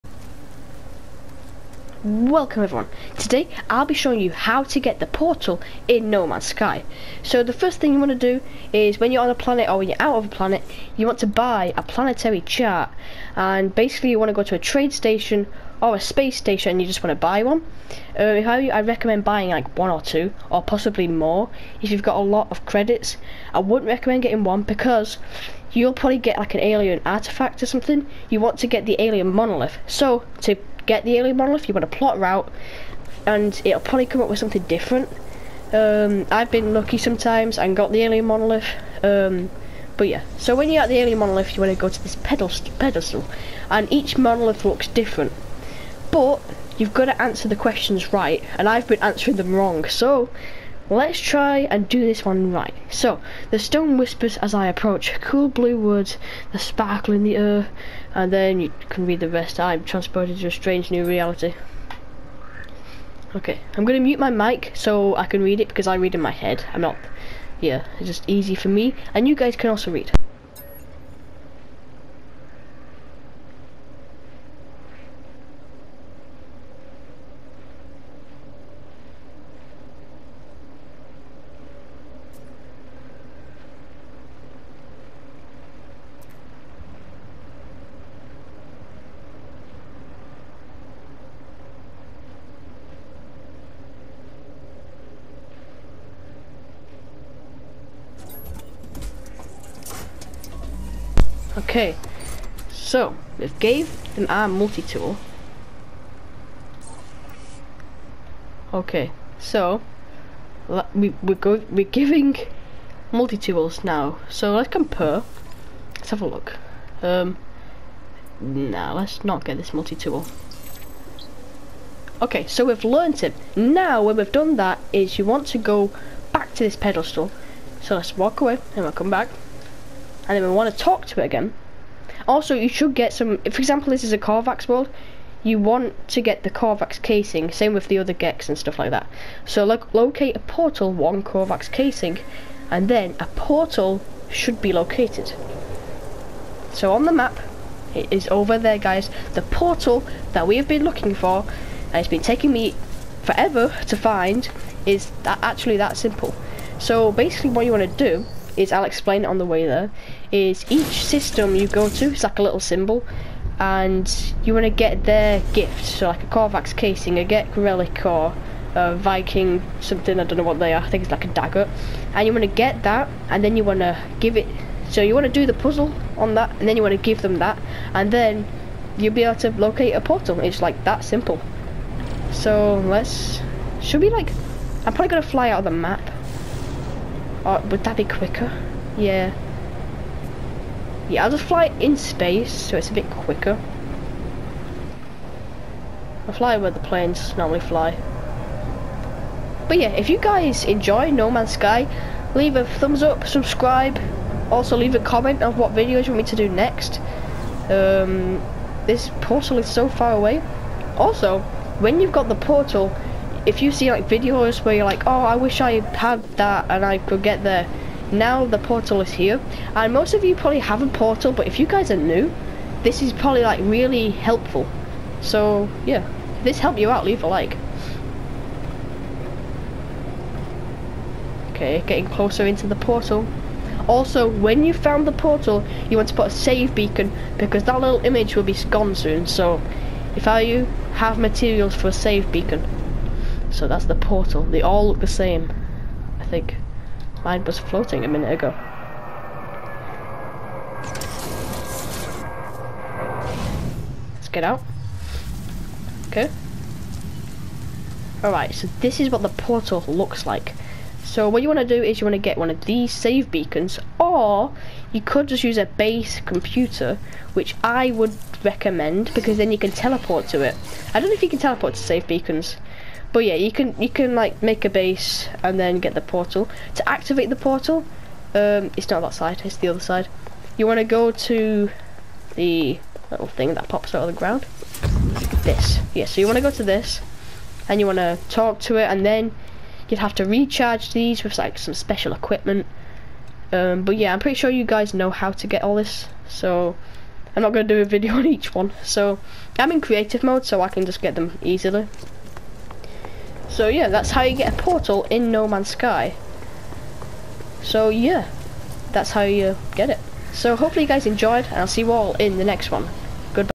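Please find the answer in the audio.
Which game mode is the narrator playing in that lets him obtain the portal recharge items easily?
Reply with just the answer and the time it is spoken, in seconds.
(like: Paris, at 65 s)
Creative mode, at 299 s.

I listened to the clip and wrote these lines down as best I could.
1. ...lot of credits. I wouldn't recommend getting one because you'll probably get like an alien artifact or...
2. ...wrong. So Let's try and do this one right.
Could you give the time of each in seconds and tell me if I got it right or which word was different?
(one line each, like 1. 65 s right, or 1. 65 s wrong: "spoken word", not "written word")
1. 22 s right
2. 49 s right.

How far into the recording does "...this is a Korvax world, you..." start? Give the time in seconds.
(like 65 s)
133 s.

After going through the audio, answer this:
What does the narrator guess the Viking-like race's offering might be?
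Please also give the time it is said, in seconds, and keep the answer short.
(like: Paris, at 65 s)
A dagger, at 171 s.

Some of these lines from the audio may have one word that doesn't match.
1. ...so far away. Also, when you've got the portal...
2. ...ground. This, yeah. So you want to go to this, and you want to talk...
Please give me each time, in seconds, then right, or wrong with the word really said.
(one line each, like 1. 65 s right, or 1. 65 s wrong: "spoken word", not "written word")
1. 209 s right
2. 284 s right.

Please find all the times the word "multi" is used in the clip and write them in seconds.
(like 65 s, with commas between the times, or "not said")
104 s, 113 s, 119 s.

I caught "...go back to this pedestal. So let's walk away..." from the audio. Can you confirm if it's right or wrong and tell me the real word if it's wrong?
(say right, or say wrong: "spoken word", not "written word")
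right.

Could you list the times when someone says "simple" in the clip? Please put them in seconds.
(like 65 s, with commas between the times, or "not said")
155 s, 181 s.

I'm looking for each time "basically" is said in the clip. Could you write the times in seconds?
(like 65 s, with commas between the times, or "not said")
13 s, 157 s.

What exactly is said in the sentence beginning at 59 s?
I'm transported to a strange new reality.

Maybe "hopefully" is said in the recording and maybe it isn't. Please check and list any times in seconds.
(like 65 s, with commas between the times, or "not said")
310 s.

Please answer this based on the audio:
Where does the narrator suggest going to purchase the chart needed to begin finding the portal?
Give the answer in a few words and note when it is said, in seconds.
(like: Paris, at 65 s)
Space station, at 15 s.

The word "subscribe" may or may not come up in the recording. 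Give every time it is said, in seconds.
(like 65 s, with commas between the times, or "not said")
203 s.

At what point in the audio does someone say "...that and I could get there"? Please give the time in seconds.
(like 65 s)
216 s.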